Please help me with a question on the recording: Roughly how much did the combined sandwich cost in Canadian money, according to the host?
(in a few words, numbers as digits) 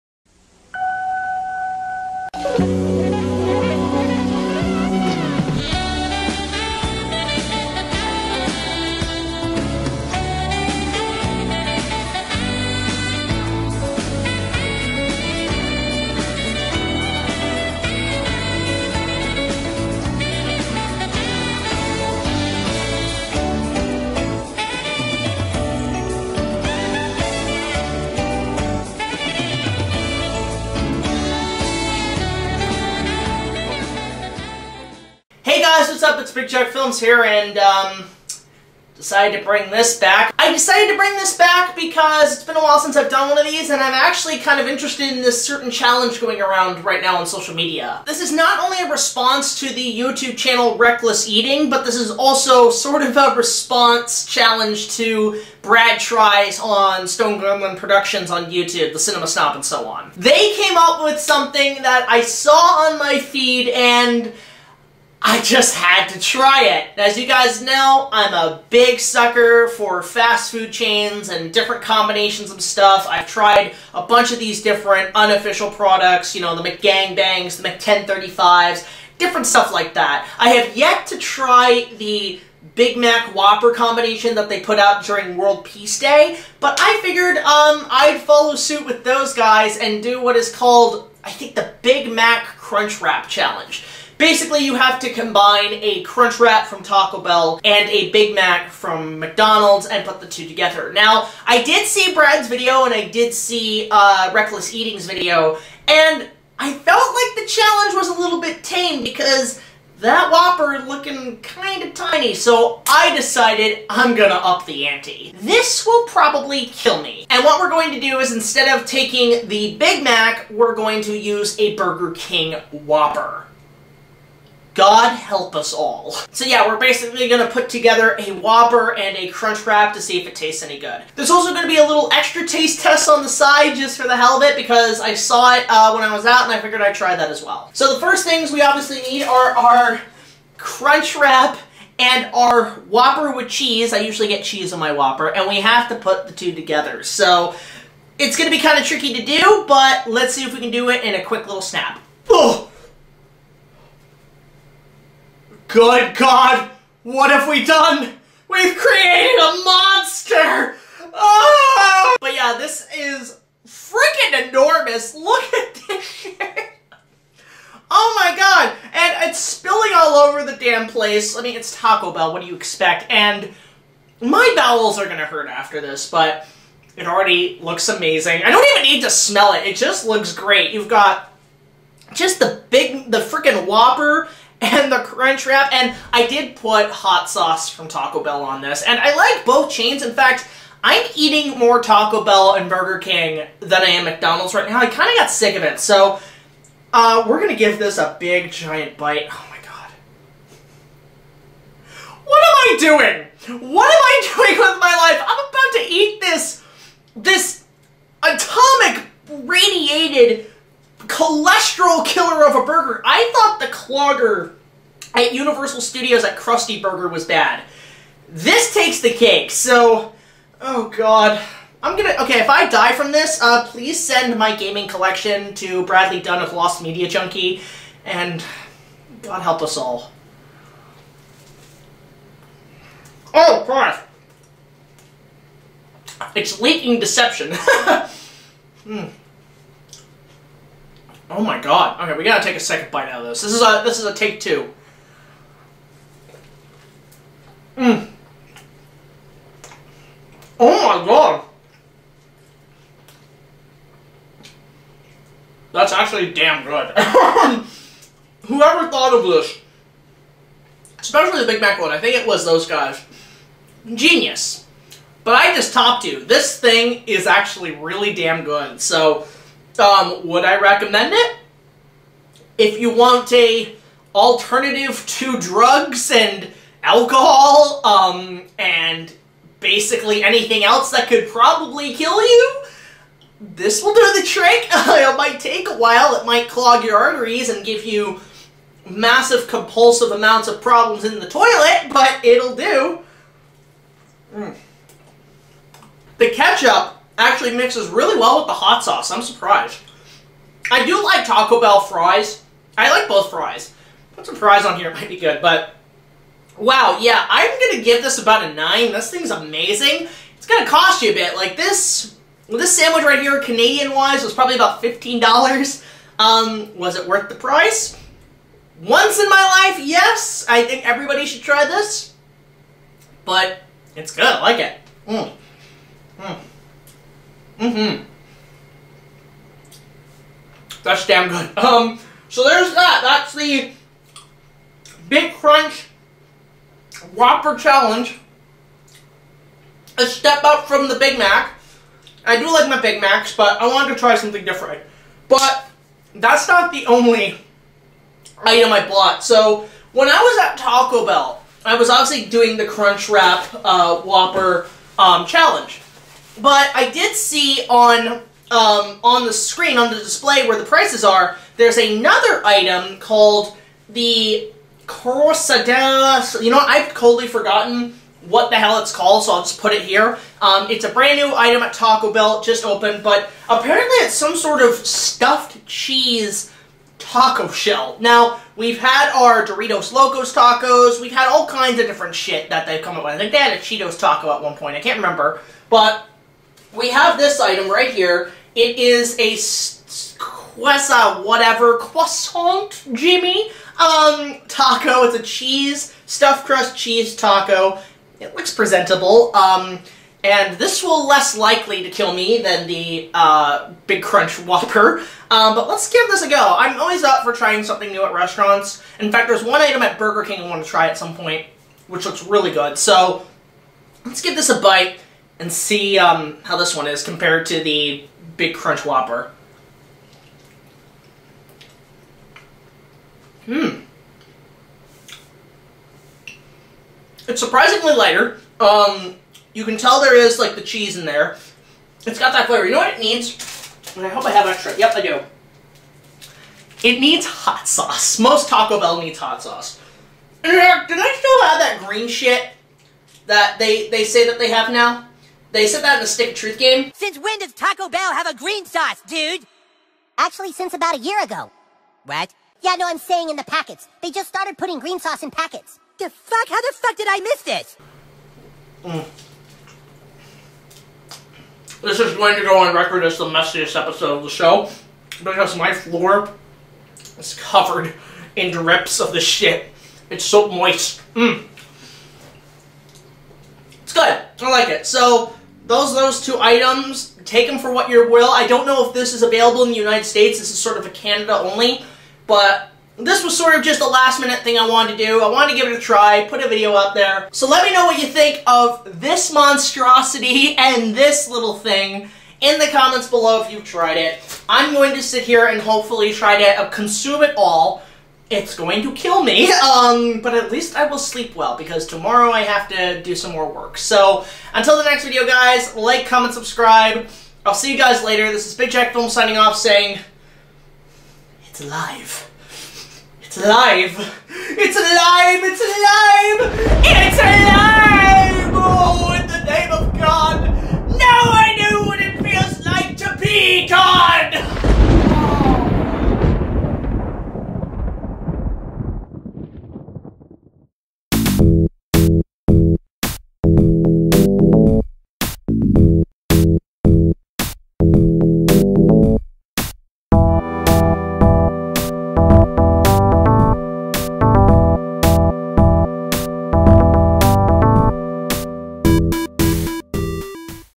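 $15.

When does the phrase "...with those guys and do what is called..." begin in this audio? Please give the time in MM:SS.
01:28.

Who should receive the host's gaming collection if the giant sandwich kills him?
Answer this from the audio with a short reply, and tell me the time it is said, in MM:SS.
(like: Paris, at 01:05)
Bradley Dunn, at 03:45.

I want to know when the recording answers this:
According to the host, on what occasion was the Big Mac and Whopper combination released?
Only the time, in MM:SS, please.
01:25.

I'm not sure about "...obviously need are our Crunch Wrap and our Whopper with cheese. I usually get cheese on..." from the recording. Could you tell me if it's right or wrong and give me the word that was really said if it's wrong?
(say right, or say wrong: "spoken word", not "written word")
right.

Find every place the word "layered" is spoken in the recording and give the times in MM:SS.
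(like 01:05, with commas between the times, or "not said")
not said.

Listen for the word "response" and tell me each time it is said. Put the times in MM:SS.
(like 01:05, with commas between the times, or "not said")
00:48, 00:53.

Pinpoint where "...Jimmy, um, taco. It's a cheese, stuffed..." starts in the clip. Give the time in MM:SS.
06:32.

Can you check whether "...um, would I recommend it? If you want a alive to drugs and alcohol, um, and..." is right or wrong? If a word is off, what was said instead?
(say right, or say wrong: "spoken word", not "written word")
wrong: "alternative", not "alive".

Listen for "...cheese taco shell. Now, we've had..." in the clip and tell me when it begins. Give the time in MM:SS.
06:15.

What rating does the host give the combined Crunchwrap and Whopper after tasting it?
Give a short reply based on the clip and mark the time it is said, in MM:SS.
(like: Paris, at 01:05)
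9, at 05:08.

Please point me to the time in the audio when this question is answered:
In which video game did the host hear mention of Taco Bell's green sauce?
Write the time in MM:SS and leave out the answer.
07:26.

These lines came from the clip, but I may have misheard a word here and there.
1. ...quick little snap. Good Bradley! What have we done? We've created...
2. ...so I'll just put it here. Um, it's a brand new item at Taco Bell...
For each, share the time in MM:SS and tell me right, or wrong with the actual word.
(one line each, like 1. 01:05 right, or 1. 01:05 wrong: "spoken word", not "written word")
1. 02:31 wrong: "God", not "Bradley"
2. 06:09 right.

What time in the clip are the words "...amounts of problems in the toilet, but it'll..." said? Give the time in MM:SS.
04:50.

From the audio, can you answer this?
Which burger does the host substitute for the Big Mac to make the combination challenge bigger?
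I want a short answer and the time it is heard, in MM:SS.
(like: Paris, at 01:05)
Burger King Whopper, at 02:01.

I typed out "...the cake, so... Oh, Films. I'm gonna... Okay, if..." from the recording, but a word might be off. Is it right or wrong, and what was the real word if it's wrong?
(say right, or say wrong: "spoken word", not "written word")
wrong: "God", not "Films".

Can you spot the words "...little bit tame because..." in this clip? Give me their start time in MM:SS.
01:48.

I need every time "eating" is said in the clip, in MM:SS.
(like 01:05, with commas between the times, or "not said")
00:51, 01:44, 03:11.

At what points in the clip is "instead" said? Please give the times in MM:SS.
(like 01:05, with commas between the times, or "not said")
01:58.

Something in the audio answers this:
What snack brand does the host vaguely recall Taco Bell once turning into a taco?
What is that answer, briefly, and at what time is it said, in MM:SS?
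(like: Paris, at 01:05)
Cheetos, at 06:23.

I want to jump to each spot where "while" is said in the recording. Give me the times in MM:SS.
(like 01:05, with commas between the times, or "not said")
00:42, 04:45.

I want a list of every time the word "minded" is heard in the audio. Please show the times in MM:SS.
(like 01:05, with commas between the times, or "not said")
not said.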